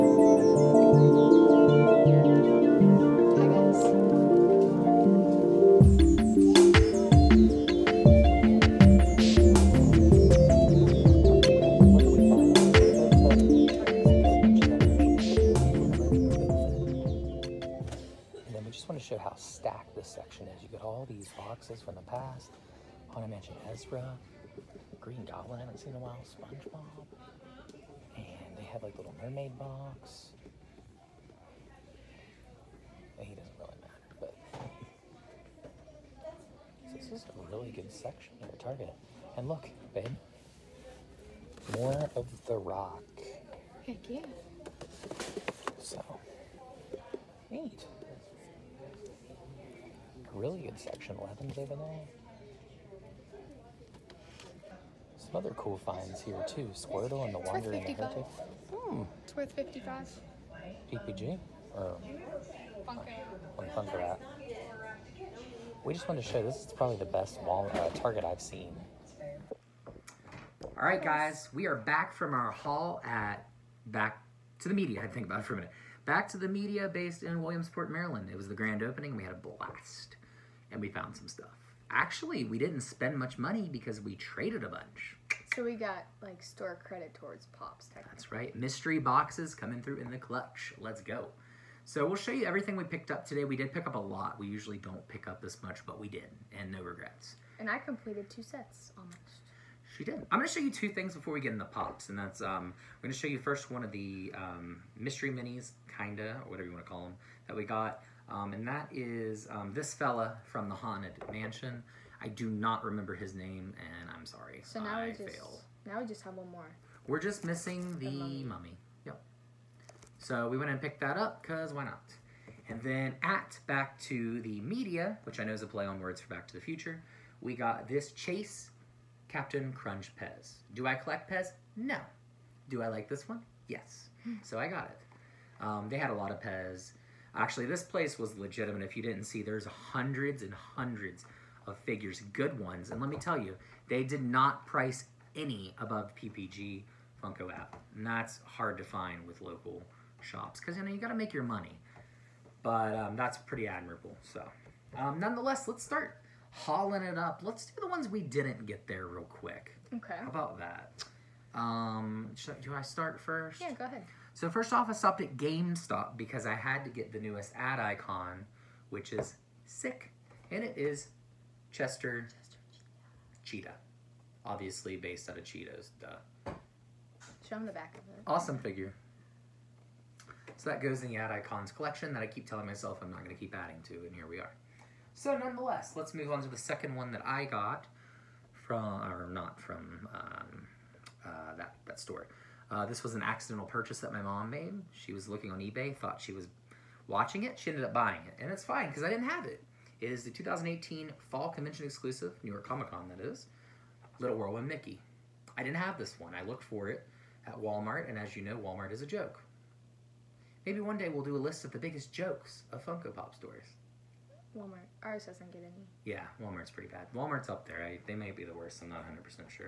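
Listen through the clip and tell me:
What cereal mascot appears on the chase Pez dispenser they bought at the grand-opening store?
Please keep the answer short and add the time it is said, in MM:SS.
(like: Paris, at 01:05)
Captain Crunch, at 02:09.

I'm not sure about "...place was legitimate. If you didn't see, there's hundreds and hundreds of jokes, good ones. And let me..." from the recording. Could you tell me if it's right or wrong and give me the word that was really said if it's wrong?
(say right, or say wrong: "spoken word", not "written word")
wrong: "figures", not "jokes".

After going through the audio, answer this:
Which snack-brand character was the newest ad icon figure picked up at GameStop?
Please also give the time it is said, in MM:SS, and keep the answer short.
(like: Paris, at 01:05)
Chester Cheetah, at 02:52.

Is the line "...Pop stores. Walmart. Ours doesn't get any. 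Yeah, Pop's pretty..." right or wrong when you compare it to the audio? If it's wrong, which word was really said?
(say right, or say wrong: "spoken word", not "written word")
wrong: "Walmart", not "Pop".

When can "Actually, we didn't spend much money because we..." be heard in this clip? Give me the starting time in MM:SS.
01:21.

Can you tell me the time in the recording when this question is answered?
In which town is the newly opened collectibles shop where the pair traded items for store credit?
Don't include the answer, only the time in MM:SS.
01:17.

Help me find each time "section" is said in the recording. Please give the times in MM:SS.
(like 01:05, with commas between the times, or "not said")
00:37, 00:50.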